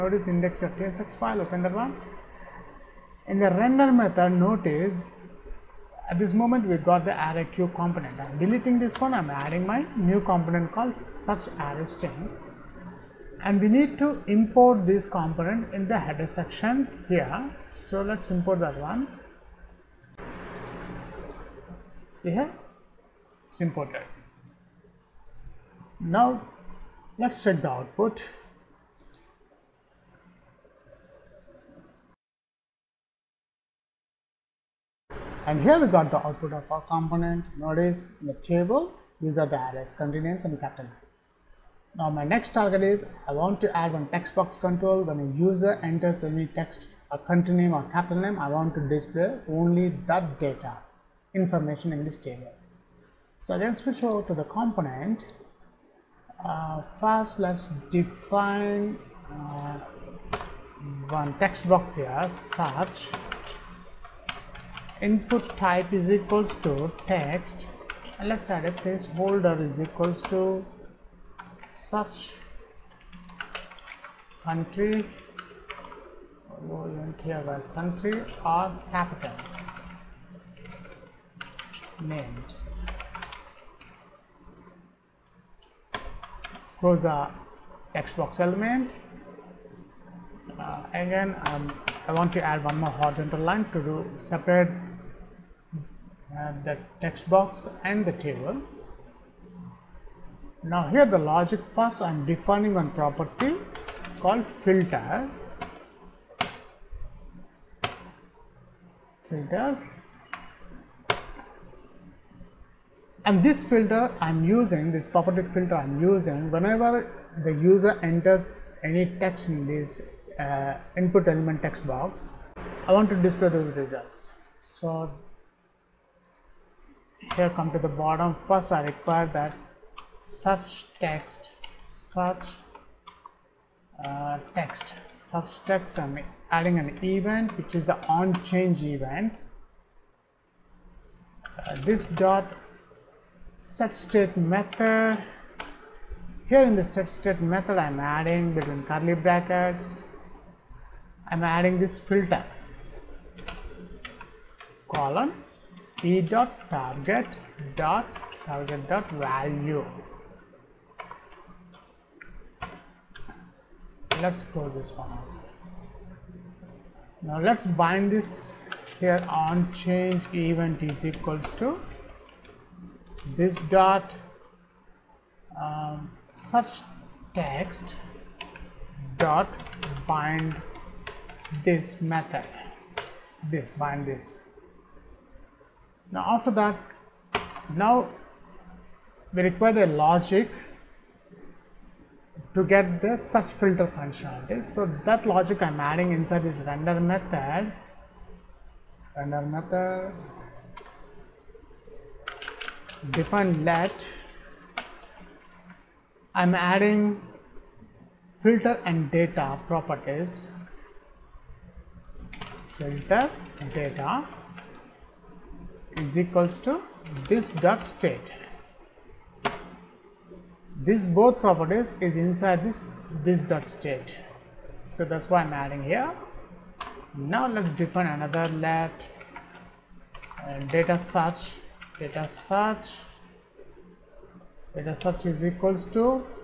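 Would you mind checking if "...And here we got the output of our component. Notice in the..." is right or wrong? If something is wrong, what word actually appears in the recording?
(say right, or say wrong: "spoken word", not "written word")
right.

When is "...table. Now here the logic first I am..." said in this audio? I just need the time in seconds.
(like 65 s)
98 s.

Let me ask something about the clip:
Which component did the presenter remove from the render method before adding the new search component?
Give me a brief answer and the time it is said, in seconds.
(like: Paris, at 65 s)
array q, at 7 s.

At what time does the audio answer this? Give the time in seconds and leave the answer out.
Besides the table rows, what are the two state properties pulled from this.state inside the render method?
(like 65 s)
208 s.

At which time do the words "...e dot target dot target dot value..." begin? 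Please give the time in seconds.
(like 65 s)
156 s.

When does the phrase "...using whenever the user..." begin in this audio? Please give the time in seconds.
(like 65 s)
116 s.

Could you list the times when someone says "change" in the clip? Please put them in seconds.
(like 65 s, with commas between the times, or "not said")
138 s, 169 s.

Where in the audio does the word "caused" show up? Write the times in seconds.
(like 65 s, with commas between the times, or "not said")
not said.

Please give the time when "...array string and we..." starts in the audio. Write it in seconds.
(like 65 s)
11 s.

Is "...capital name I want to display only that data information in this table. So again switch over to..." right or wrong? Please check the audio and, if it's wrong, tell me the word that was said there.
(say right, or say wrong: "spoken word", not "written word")
right.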